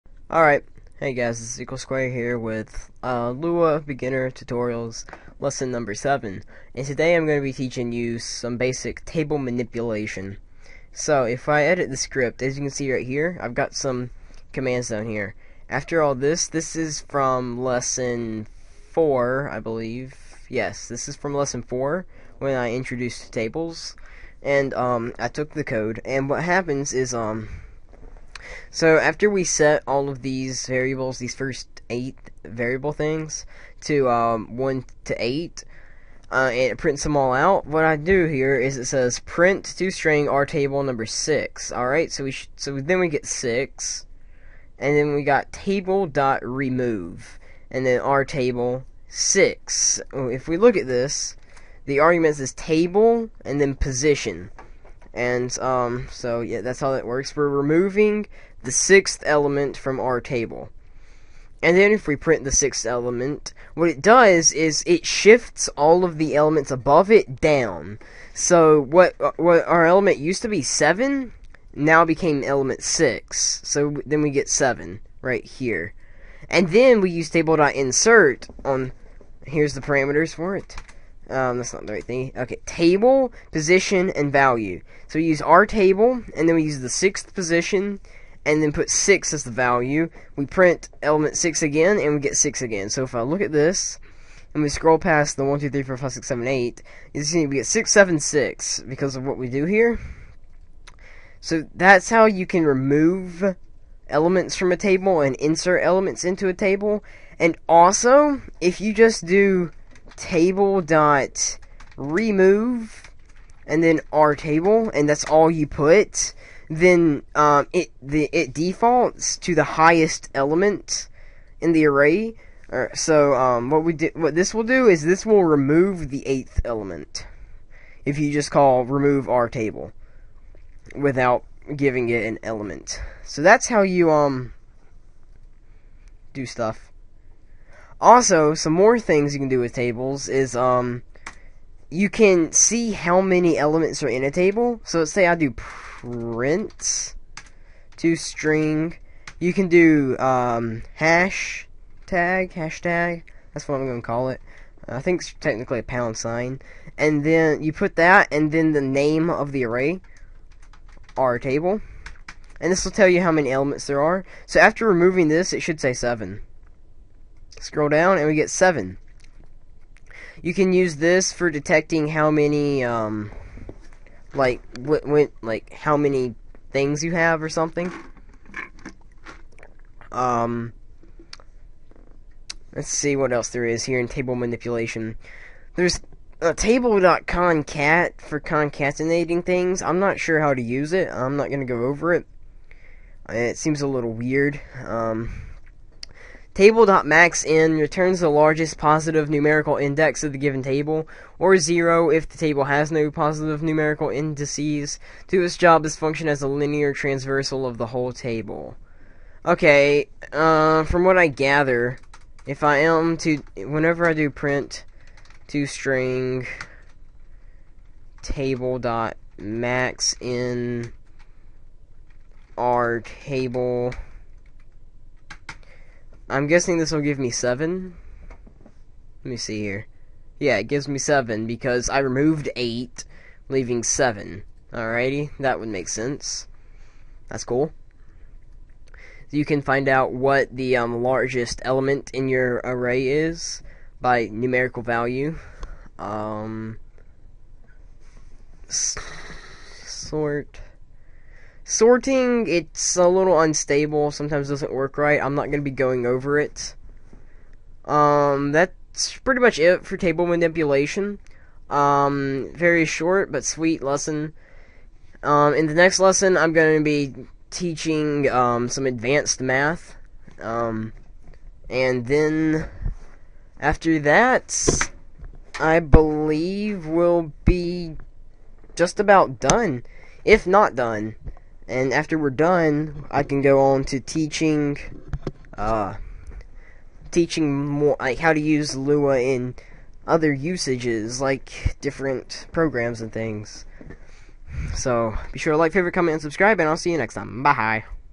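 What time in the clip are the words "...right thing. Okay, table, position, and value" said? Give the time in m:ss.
1:21.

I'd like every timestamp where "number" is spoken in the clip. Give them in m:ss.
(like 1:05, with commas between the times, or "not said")
0:05, 0:40.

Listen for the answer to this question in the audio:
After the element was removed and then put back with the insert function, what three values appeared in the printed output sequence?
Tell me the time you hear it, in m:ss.
1:37.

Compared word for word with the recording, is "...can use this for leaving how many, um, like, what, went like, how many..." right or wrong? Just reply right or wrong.
wrong.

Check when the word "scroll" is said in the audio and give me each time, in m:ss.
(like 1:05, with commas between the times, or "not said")
1:34, 2:47.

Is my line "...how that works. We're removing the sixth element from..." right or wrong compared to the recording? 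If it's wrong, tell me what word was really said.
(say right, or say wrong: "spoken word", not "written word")
right.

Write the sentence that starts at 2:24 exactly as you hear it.
So let's say I do print to string.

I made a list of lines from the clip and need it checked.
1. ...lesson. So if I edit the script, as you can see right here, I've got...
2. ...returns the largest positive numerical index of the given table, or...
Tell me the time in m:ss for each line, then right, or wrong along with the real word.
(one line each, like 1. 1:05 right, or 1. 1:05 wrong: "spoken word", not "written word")
1. 0:09 wrong: "manipulation", not "lesson"
2. 3:17 right.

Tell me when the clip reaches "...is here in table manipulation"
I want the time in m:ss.
3:03.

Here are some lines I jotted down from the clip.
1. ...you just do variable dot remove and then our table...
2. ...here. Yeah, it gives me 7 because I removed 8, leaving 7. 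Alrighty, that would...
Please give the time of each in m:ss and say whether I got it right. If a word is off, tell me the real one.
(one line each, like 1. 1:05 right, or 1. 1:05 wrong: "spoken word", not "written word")
1. 1:48 wrong: "table", not "variable"
2. 3:49 right.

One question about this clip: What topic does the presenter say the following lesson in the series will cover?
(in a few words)
Advanced math.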